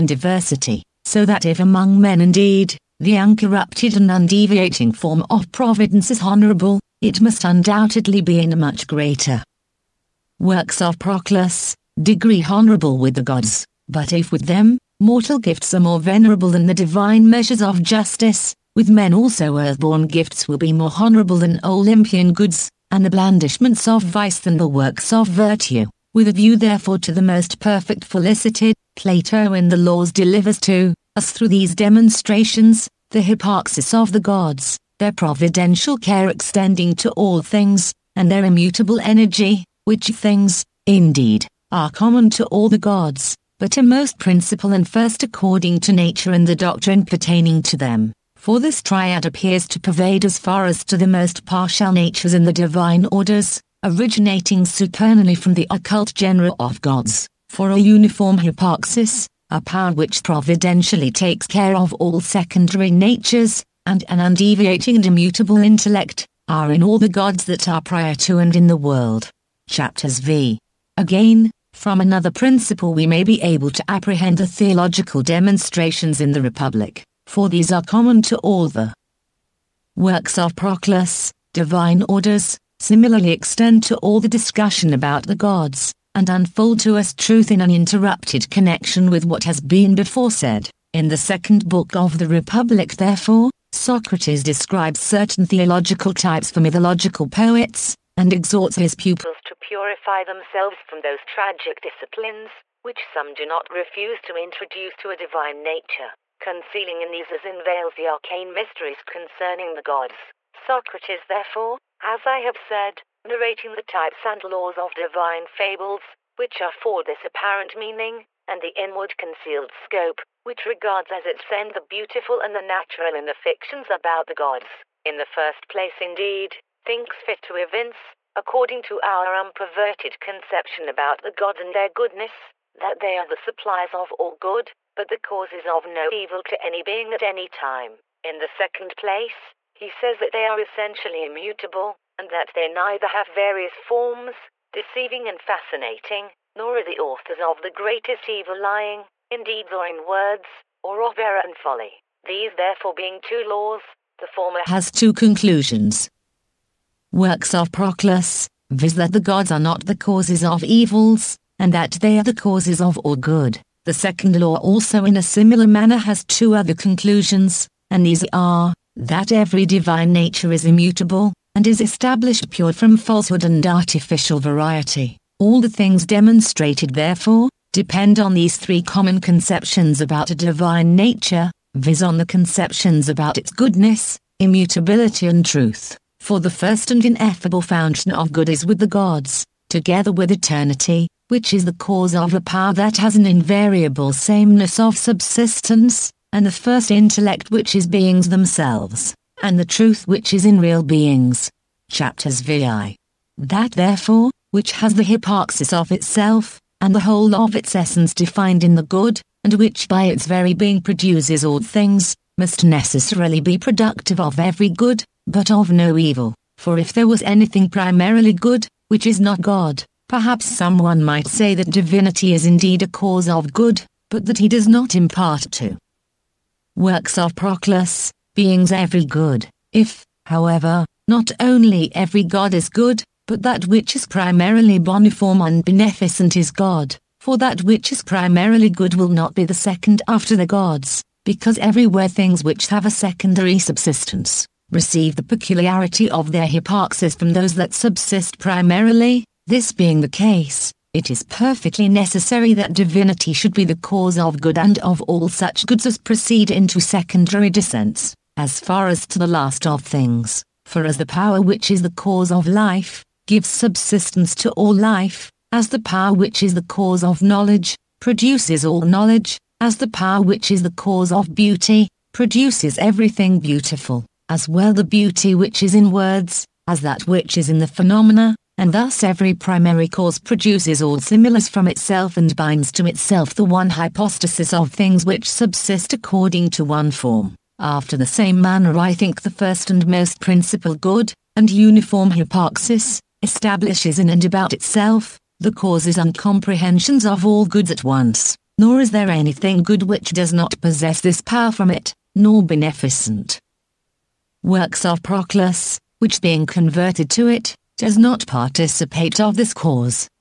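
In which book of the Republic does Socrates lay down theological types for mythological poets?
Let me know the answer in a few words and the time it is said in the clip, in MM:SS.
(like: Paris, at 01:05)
second book, at 01:31.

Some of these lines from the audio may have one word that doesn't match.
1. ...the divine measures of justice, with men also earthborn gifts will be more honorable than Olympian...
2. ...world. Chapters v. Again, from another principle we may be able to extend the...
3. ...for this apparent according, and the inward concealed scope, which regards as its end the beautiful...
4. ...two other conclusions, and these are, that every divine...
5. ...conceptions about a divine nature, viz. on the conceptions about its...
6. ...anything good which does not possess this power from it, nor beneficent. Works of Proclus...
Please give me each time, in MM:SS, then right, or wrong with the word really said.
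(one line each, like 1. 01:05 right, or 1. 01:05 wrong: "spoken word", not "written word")
1. 00:16 right
2. 01:08 wrong: "apprehend", not "extend"
3. 01:56 wrong: "meaning", not "according"
4. 02:46 right
5. 02:59 right
6. 04:59 right.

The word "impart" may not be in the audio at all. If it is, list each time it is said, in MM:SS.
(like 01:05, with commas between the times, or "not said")
03:44.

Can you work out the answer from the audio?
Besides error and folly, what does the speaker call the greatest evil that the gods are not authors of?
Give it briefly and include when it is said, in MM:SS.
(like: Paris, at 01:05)
lying, at 02:28.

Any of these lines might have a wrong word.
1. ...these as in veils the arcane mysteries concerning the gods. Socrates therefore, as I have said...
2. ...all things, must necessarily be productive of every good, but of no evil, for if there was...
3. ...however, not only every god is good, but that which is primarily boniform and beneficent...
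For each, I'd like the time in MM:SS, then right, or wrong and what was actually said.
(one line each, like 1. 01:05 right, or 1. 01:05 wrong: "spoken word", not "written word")
1. 01:47 right
2. 03:31 right
3. 03:50 right.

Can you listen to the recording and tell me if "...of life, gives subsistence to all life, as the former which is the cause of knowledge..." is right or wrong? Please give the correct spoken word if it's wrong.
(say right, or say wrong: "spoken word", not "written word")
wrong: "power", not "former".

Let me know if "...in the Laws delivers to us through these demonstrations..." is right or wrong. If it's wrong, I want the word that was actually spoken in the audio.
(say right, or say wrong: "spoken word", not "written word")
right.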